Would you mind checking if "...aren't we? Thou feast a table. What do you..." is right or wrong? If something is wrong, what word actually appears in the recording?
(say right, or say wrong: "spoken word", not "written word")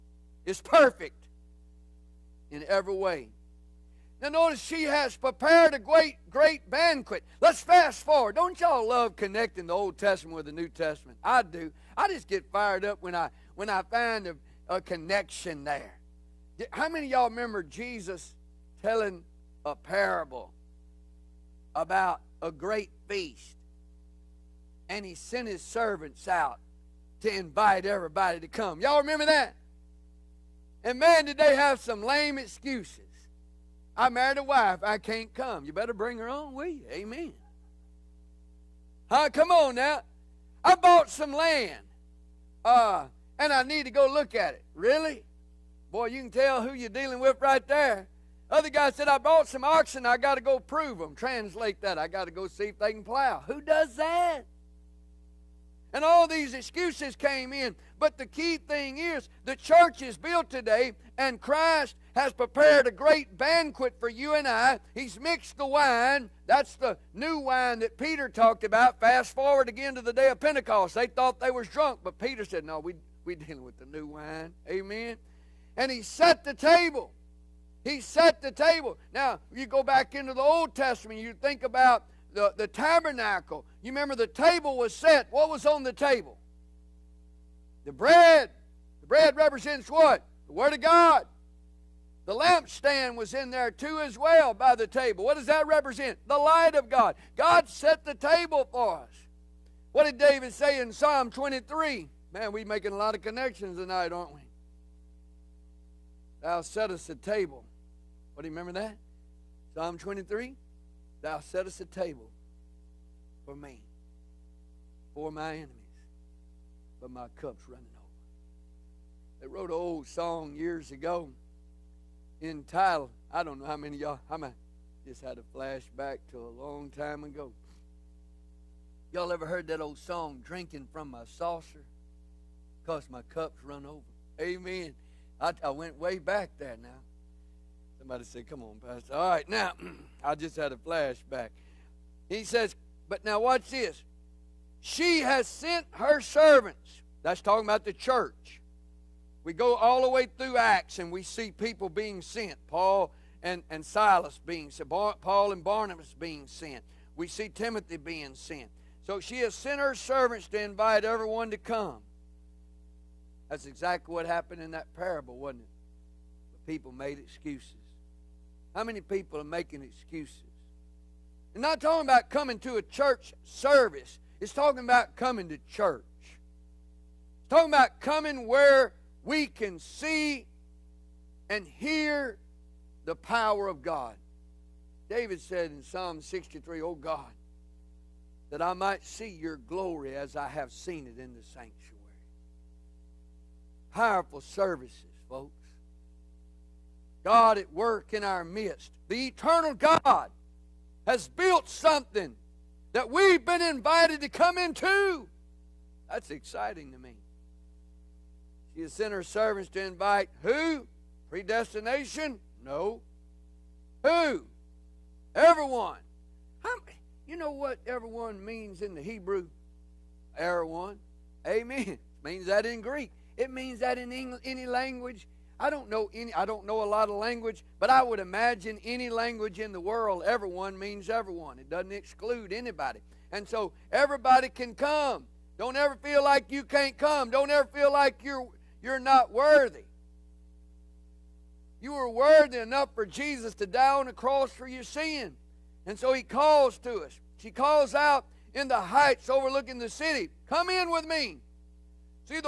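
wrong: "settest", not "feast".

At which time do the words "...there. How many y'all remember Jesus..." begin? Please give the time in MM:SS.
00:15.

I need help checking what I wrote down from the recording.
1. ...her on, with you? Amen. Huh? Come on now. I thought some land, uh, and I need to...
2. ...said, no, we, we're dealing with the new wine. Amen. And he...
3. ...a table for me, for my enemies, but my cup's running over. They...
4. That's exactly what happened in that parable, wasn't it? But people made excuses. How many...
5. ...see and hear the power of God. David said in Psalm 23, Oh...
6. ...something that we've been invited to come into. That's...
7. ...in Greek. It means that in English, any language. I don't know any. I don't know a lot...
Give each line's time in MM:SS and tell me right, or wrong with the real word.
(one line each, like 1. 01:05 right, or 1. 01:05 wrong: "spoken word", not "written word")
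1. 00:36 wrong: "bought", not "thought"
2. 01:12 right
3. 01:51 right
4. 02:43 right
5. 02:59 wrong: "63", not "23"
6. 03:21 right
7. 03:42 right.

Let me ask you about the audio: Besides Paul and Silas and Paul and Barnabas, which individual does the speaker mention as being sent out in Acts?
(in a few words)
Timothy.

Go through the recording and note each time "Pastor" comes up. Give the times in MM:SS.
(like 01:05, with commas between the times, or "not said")
02:18.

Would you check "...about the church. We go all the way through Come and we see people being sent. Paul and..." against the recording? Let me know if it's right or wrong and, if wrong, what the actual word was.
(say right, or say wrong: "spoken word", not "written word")
wrong: "Acts", not "Come".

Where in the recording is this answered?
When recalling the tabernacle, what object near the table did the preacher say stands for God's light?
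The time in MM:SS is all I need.
01:32.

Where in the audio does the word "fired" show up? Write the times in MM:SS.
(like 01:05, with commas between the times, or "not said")
00:12.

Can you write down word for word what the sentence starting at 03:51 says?
It doesn't exclude anybody, and so everybody can come.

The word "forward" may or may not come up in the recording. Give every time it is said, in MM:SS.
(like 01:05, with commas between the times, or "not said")
00:08, 01:09.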